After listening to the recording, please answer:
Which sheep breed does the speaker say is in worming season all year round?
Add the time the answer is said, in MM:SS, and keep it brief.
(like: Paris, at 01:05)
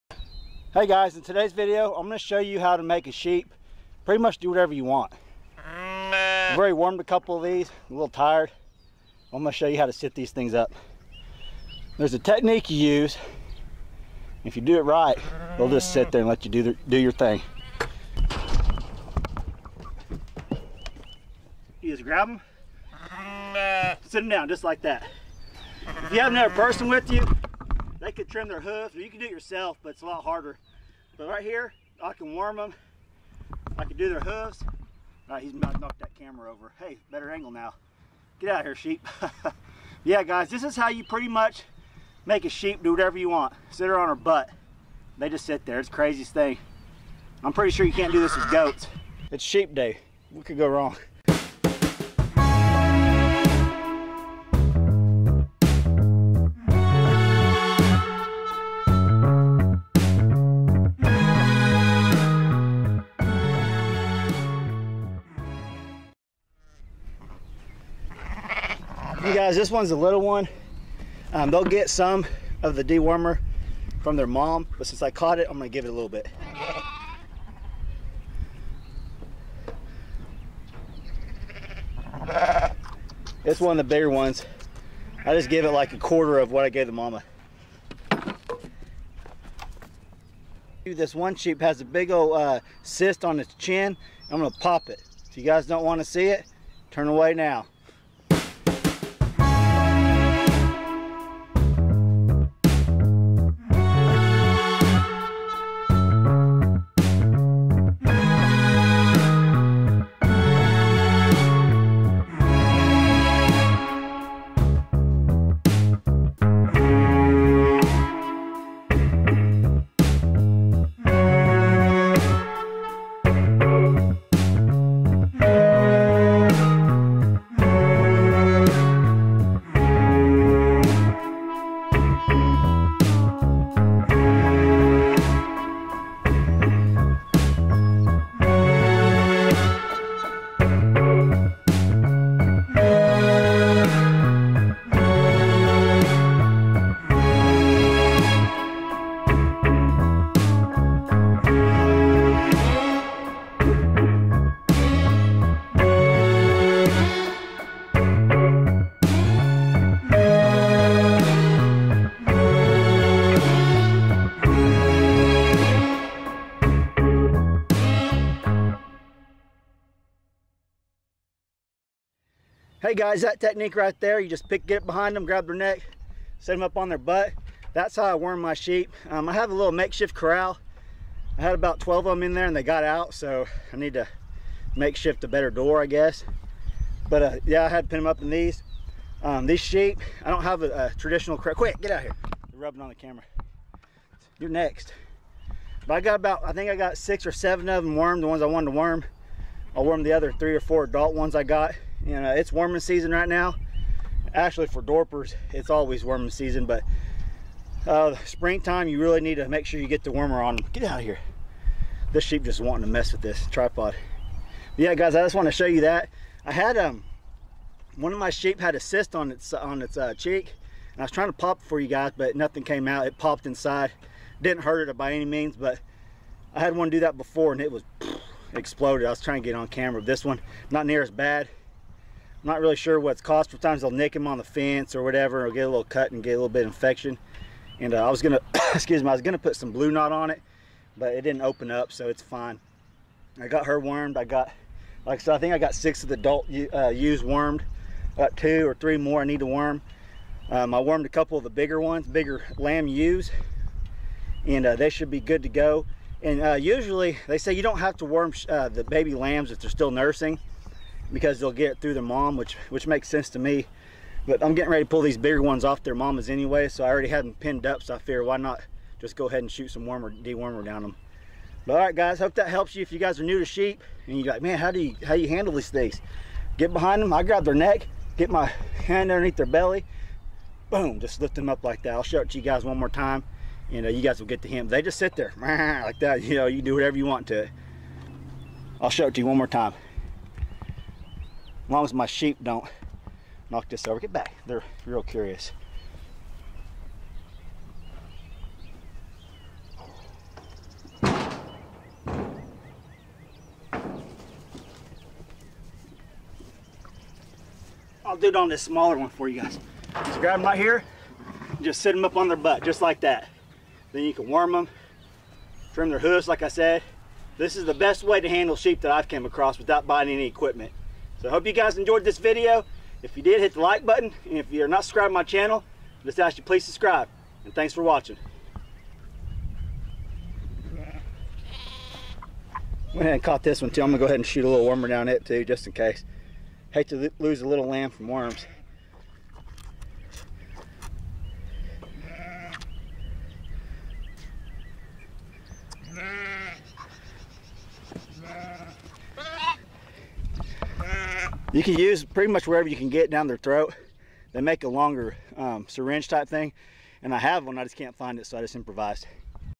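Dorpers, at 03:24.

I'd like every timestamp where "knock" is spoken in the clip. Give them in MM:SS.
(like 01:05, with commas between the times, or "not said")
00:35, 04:53.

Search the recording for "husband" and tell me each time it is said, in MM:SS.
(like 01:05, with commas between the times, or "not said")
not said.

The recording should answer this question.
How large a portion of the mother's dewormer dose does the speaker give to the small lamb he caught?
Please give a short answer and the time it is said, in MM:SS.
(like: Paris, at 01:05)
a quarter, at 01:25.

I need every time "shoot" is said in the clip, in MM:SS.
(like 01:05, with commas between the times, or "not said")
04:29, 05:34.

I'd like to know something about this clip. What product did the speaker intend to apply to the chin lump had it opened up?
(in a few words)
Blu-Kote.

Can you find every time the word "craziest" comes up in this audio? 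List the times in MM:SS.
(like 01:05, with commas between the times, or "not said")
00:45.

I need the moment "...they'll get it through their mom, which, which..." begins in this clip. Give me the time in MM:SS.
04:21.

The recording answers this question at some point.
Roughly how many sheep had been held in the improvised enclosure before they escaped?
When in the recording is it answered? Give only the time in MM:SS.
03:01.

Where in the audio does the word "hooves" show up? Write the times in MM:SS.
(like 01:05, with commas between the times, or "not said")
00:28, 00:34, 05:15.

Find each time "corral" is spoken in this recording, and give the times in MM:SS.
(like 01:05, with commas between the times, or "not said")
03:00, 03:11.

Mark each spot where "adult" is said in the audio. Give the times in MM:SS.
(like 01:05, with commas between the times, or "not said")
03:20, 04:06.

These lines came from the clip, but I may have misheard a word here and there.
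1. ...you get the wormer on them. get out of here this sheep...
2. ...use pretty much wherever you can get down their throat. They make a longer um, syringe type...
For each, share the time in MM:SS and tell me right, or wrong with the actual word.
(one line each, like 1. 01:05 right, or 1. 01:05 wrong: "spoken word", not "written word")
1. 03:29 right
2. 05:51 right.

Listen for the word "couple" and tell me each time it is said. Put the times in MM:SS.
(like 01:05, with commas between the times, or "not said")
00:07, 04:11.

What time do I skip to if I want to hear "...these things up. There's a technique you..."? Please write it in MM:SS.
00:10.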